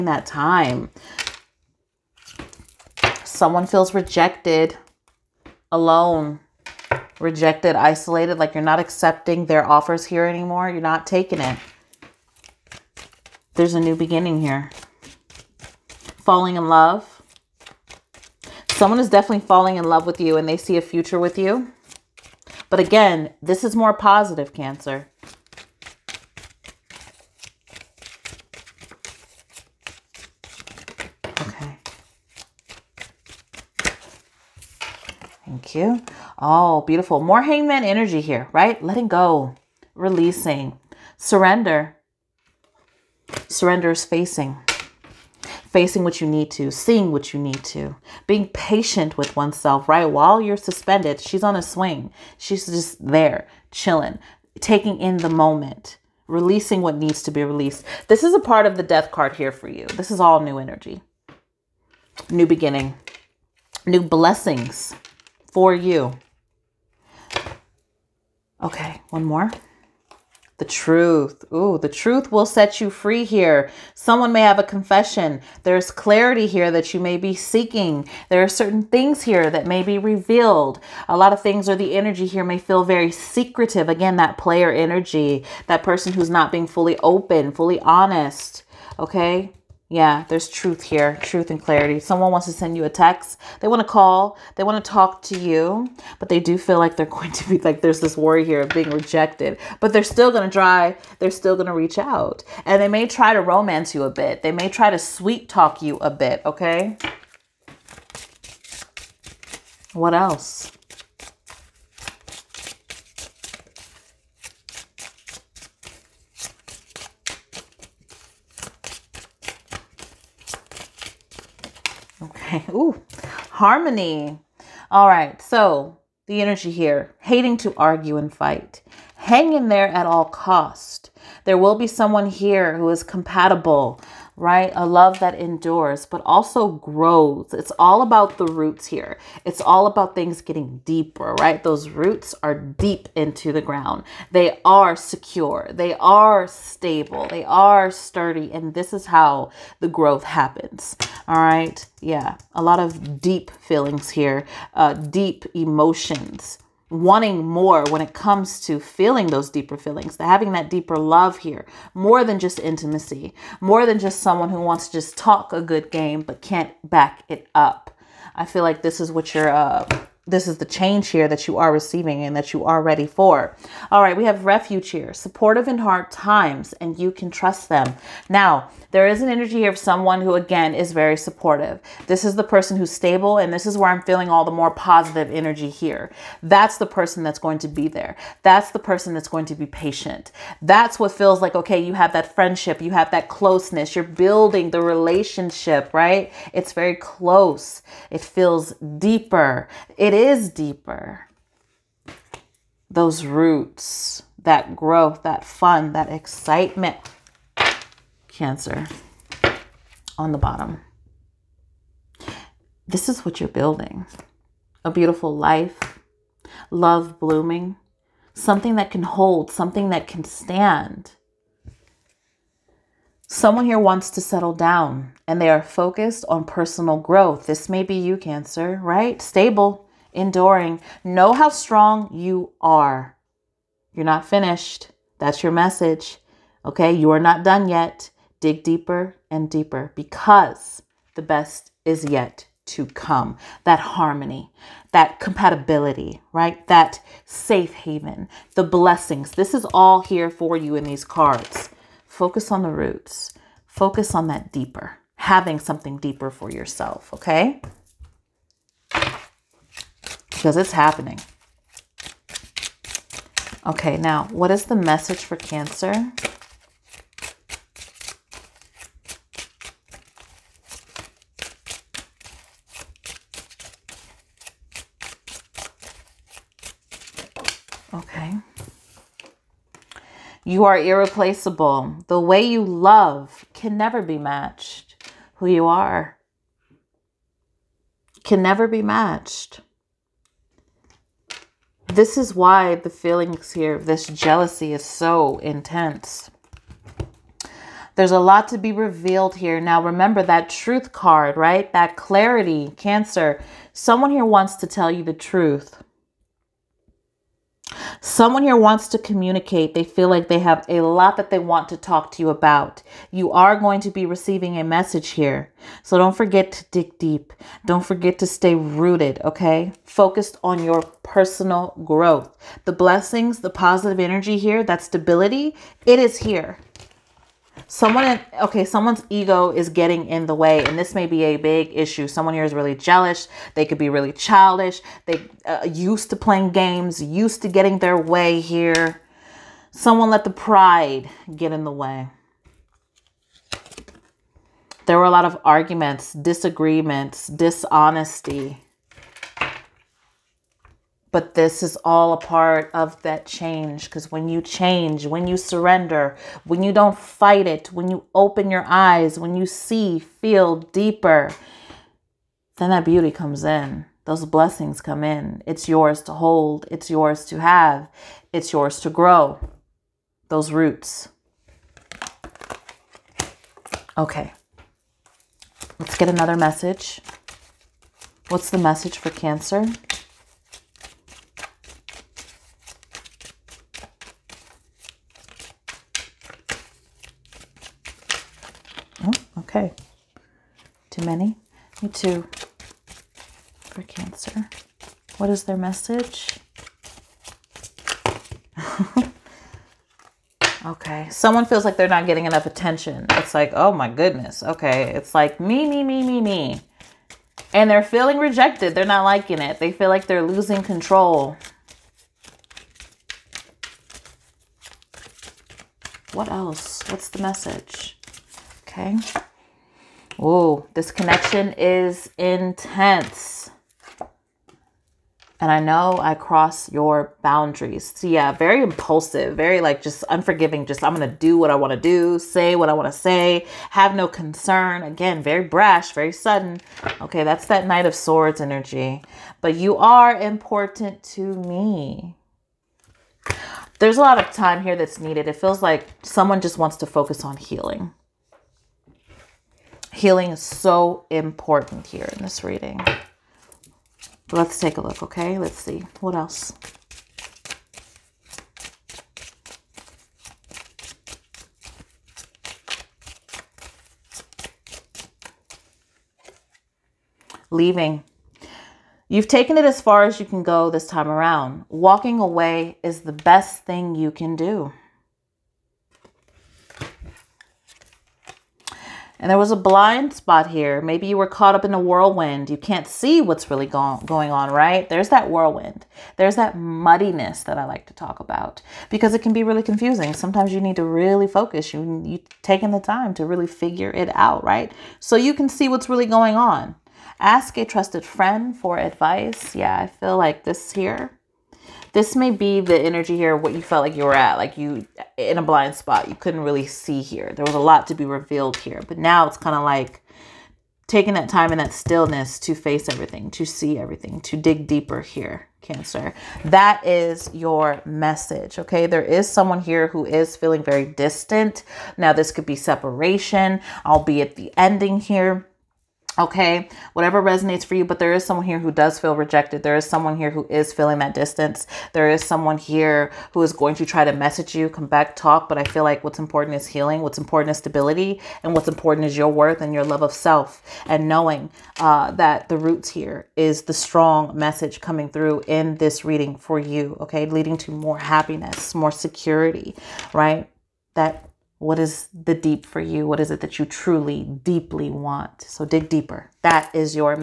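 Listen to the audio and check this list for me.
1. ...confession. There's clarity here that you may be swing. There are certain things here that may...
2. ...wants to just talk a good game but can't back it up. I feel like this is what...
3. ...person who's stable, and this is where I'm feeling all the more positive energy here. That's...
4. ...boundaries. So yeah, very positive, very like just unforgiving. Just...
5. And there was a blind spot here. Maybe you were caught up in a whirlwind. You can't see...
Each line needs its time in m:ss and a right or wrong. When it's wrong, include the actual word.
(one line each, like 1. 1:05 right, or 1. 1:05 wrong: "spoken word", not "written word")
1. 1:14 wrong: "seeking", not "swing"
2. 2:44 right
3. 3:02 right
4. 7:07 wrong: "impulsive", not "positive"
5. 7:59 right.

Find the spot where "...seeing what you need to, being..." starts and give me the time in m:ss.
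0:46.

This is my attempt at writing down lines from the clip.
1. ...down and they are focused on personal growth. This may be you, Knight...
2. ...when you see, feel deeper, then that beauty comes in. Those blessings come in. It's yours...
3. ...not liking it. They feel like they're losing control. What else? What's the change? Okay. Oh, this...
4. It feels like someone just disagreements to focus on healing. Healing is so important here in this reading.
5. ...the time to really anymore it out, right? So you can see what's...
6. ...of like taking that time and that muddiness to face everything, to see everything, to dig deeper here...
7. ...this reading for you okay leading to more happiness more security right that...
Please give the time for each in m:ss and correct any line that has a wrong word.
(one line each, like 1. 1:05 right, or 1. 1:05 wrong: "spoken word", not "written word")
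1. 3:44 wrong: "Cancer", not "Knight"
2. 5:59 right
3. 6:48 wrong: "message", not "change"
4. 7:25 wrong: "wants", not "disagreements"
5. 8:12 wrong: "figure", not "anymore"
6. 8:29 wrong: "stillness", not "muddiness"
7. 9:05 right.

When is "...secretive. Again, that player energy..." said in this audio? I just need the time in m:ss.
1:23.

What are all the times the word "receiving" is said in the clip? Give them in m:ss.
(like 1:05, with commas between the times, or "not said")
2:51, 5:14.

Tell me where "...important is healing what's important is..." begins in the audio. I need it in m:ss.
8:56.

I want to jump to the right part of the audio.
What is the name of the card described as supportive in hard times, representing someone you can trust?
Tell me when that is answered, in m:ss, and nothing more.
2:54.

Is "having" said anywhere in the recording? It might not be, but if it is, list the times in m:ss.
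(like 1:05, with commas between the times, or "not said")
2:40, 4:15.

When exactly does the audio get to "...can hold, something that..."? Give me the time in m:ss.
3:38.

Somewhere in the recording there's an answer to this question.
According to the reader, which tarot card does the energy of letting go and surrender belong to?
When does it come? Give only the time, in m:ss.
0:58.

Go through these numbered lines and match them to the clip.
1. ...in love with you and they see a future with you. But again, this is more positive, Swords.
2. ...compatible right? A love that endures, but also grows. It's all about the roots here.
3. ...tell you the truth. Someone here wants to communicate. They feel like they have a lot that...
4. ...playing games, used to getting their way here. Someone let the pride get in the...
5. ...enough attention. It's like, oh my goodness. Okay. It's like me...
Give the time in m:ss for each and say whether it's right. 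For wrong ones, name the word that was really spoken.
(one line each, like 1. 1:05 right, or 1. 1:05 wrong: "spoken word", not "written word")
1. 0:19 wrong: "Cancer", not "Swords"
2. 2:13 right
3. 5:04 right
4. 5:36 right
5. 6:42 right.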